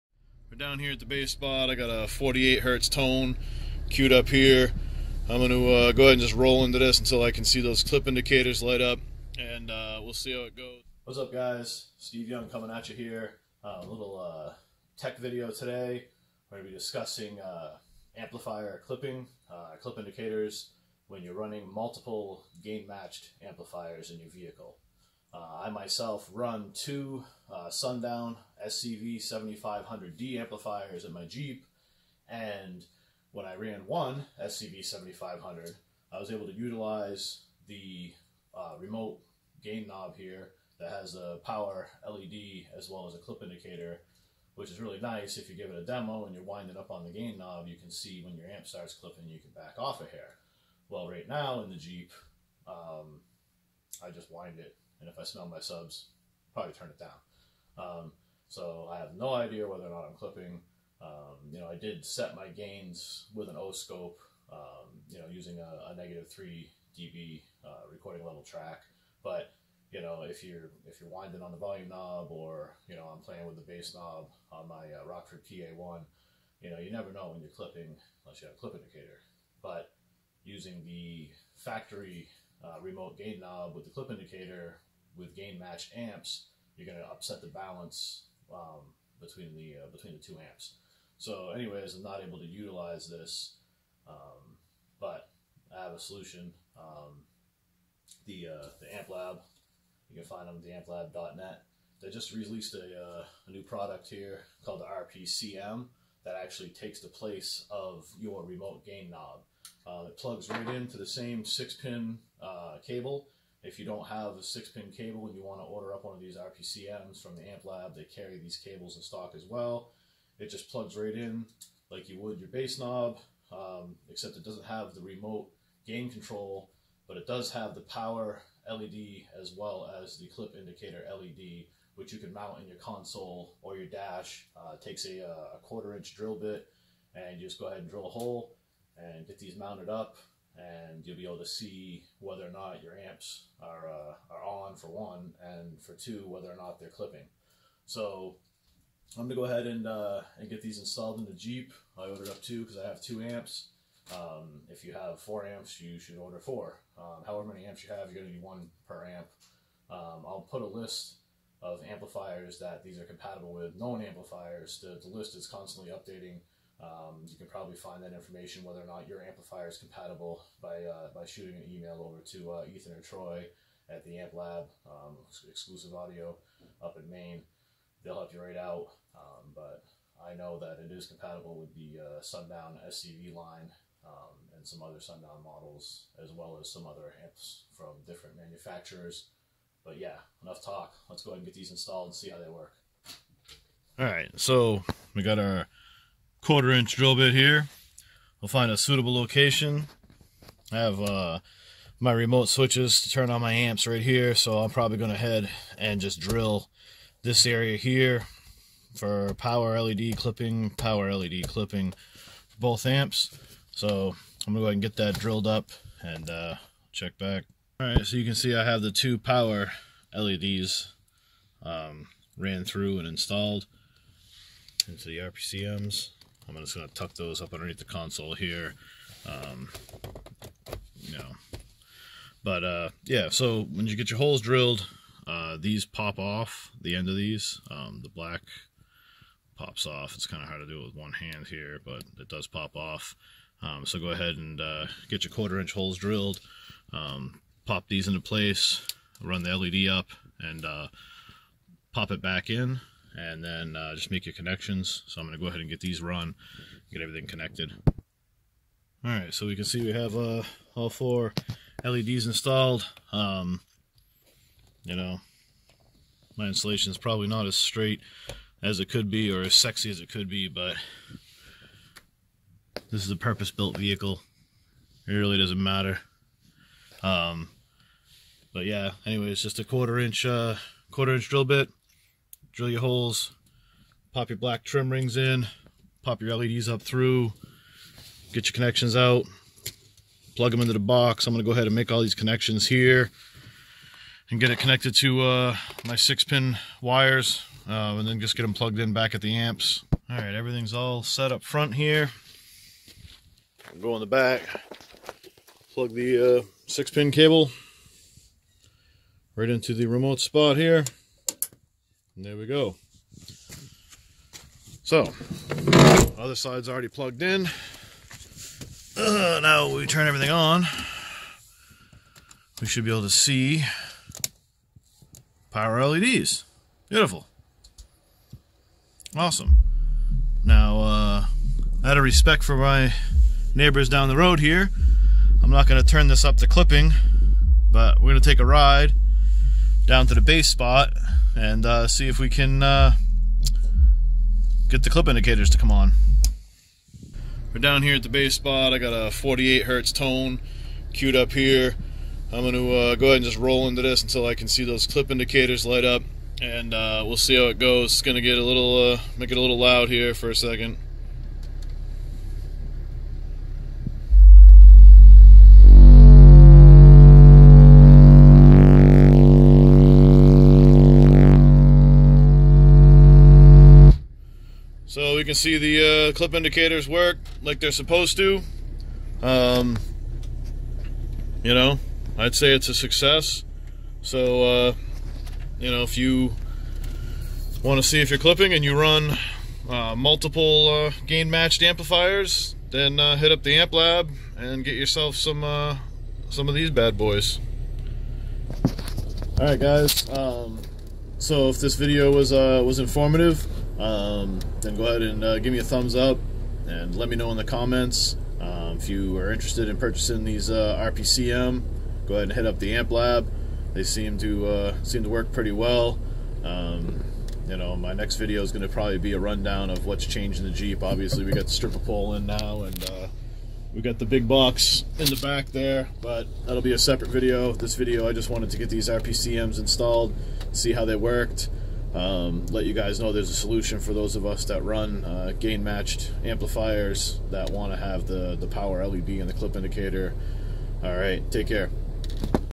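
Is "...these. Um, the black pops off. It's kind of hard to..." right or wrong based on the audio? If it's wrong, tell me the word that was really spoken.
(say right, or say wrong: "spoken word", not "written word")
right.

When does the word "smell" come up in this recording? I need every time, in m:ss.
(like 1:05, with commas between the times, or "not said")
0:55.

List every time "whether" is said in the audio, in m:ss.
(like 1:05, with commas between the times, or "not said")
0:59, 2:22, 2:26, 2:48.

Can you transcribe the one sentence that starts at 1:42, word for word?
They just released a, uh, a new product here called the RPCM that actually takes the place of your remote gain knob.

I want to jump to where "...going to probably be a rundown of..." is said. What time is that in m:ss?
6:58.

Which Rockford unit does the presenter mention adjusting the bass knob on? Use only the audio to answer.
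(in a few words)
Rockford PA1.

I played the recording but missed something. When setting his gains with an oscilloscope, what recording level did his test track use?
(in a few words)
-3 dB.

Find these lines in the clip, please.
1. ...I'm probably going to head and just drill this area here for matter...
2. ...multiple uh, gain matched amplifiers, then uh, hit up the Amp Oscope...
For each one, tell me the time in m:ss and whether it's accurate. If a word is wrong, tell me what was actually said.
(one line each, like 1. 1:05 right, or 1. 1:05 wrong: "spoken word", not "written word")
1. 3:24 wrong: "power", not "matter"
2. 6:29 wrong: "Lab", not "Oscope".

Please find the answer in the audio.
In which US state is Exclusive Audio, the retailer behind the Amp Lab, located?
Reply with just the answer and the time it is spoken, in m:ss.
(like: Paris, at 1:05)
Maine, at 2:57.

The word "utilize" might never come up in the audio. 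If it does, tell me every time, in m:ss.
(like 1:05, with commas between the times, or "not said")
0:36, 1:32.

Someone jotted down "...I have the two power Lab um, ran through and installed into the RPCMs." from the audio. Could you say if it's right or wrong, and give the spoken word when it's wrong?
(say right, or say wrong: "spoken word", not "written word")
wrong: "LEDs", not "Lab".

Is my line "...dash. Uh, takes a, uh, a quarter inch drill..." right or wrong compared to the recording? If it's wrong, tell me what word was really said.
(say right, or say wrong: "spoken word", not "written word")
right.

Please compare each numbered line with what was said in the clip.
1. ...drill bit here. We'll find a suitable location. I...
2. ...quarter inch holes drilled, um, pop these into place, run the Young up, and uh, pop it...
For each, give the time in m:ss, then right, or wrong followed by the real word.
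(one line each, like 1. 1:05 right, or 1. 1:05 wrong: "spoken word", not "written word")
1. 3:16 right
2. 4:05 wrong: "LED", not "Young".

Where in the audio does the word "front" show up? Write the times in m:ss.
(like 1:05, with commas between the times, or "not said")
5:01.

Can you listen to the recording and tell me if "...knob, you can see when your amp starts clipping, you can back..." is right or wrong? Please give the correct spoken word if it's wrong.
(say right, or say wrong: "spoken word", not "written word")
right.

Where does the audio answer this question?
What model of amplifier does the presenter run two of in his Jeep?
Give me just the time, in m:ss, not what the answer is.
0:27.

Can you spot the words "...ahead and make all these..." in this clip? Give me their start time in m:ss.
4:51.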